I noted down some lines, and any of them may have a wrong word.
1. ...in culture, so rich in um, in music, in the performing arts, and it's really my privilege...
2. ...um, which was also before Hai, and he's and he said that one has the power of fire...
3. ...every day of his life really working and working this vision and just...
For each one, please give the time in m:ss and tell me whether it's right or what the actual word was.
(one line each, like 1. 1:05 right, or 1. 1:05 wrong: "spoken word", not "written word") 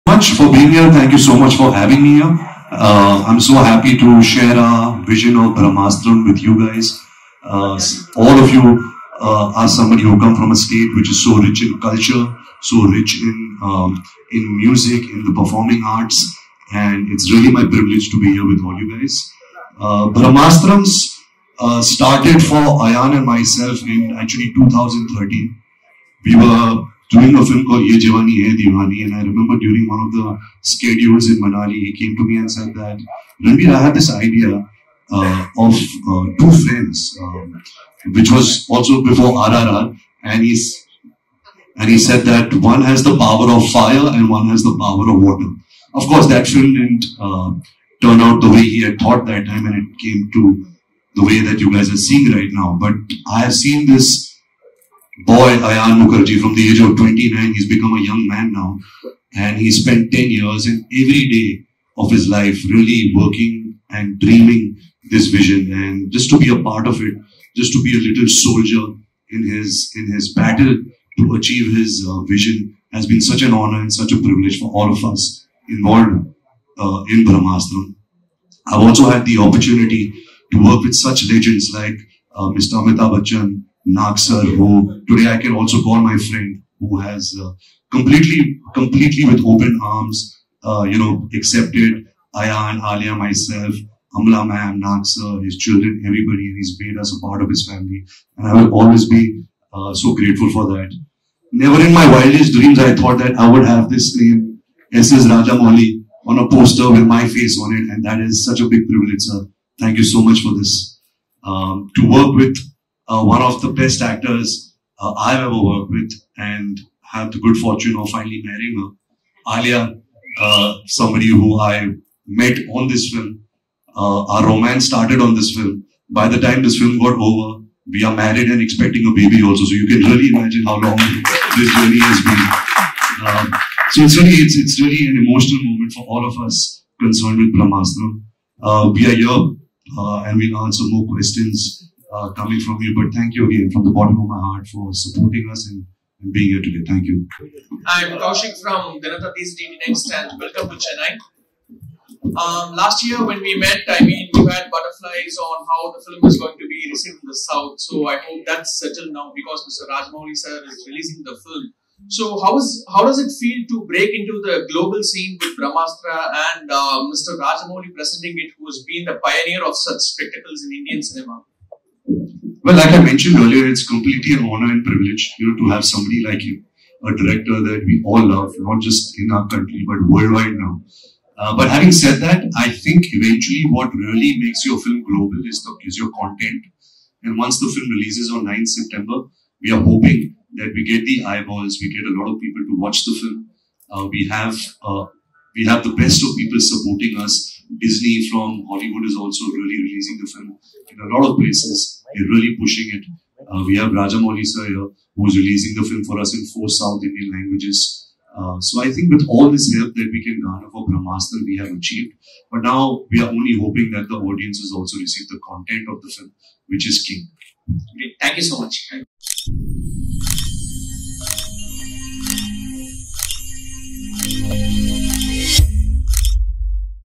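1. 0:11 right
2. 0:37 wrong: "RRR", not "Hai"
3. 1:00 wrong: "dreaming", not "working".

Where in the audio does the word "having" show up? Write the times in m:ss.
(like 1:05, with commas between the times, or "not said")
0:01, 3:01.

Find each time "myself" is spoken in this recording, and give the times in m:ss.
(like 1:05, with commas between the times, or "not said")
0:23, 1:33.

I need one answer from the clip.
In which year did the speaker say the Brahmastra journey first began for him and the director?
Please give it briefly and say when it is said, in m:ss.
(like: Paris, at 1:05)
2013, at 0:24.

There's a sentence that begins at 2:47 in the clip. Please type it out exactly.
Rajamouli presenting it, who has been the pioneer of such spectacles in Indian cinema?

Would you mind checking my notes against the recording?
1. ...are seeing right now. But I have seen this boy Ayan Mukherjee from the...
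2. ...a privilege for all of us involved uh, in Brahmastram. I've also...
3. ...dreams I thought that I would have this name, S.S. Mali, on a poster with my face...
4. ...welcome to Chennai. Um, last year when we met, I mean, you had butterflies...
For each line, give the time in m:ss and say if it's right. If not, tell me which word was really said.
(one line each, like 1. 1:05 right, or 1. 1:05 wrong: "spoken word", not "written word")
1. 0:51 right
2. 1:14 right
3. 1:42 right
4. 2:30 right.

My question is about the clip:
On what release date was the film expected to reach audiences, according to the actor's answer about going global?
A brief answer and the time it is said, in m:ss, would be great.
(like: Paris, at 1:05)
9th September, at 3:08.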